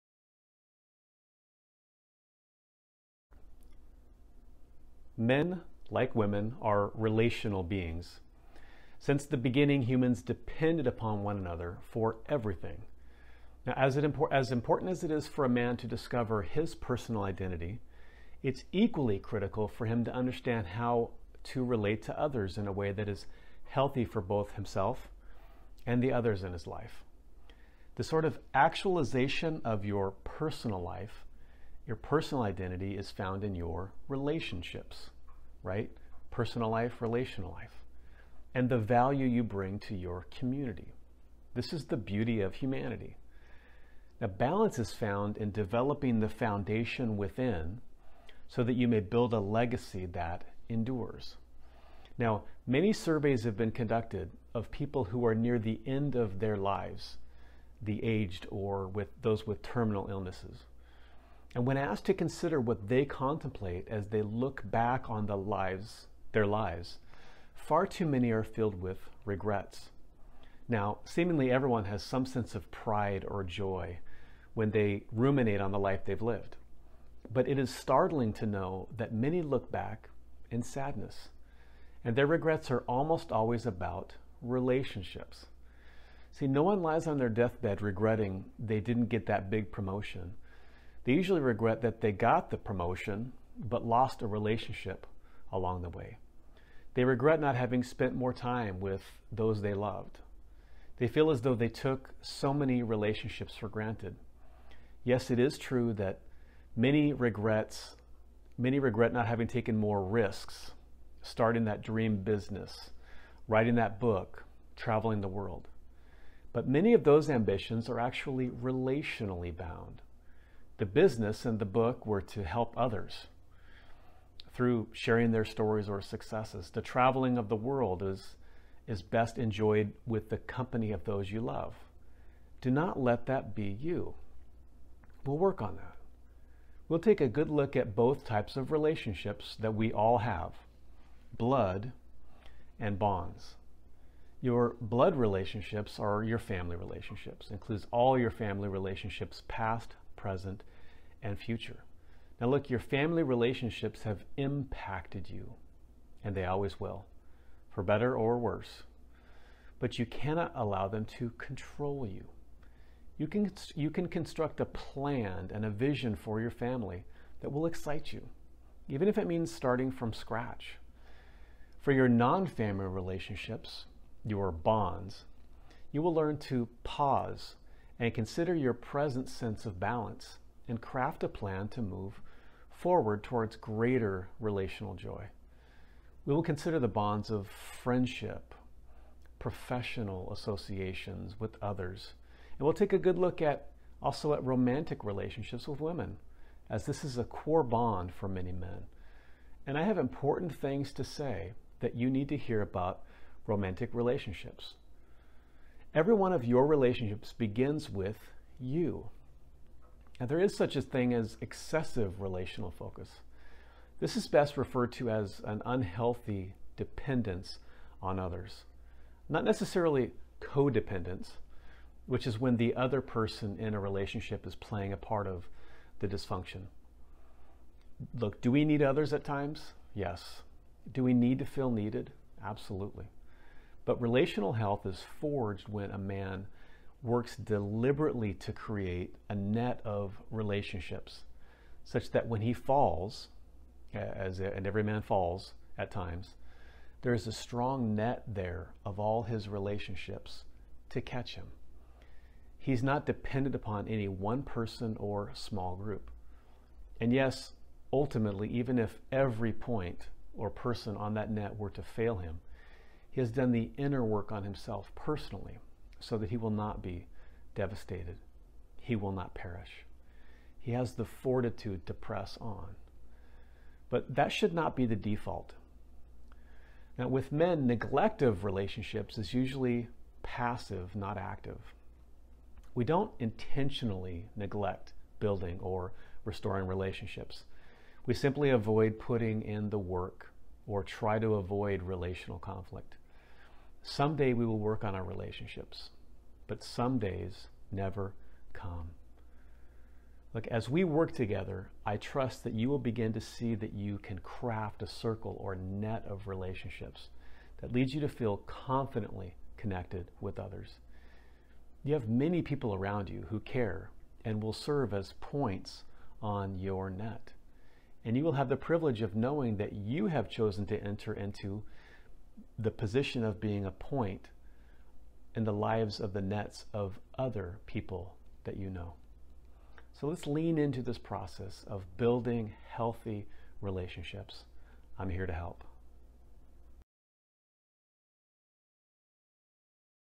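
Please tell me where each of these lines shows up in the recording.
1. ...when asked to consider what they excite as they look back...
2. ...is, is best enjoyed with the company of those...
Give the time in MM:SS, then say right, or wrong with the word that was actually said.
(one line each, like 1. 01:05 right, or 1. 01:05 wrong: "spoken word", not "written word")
1. 01:01 wrong: "contemplate", not "excite"
2. 02:08 right.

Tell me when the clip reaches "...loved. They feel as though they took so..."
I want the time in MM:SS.
01:39.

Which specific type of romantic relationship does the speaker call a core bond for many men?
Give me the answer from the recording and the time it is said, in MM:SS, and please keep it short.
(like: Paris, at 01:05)
romantic relationships with women, at 03:14.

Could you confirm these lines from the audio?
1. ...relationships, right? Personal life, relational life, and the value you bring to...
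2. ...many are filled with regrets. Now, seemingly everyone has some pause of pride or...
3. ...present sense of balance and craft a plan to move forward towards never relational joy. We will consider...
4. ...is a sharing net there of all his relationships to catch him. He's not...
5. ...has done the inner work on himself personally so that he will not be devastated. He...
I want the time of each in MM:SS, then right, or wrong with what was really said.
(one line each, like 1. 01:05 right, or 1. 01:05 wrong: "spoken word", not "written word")
1. 00:34 right
2. 01:08 wrong: "sense", not "pause"
3. 02:58 wrong: "greater", not "never"
4. 04:07 wrong: "strong", not "sharing"
5. 04:23 right.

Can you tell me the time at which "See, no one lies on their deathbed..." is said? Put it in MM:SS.
01:26.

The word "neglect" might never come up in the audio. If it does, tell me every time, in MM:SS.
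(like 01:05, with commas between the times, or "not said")
04:37, 04:44.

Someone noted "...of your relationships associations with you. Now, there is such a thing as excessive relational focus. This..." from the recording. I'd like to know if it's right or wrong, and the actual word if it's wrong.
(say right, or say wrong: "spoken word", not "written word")
wrong: "begins", not "associations".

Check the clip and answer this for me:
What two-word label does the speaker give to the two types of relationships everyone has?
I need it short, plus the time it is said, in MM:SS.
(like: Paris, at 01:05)
blood and bonds, at 02:21.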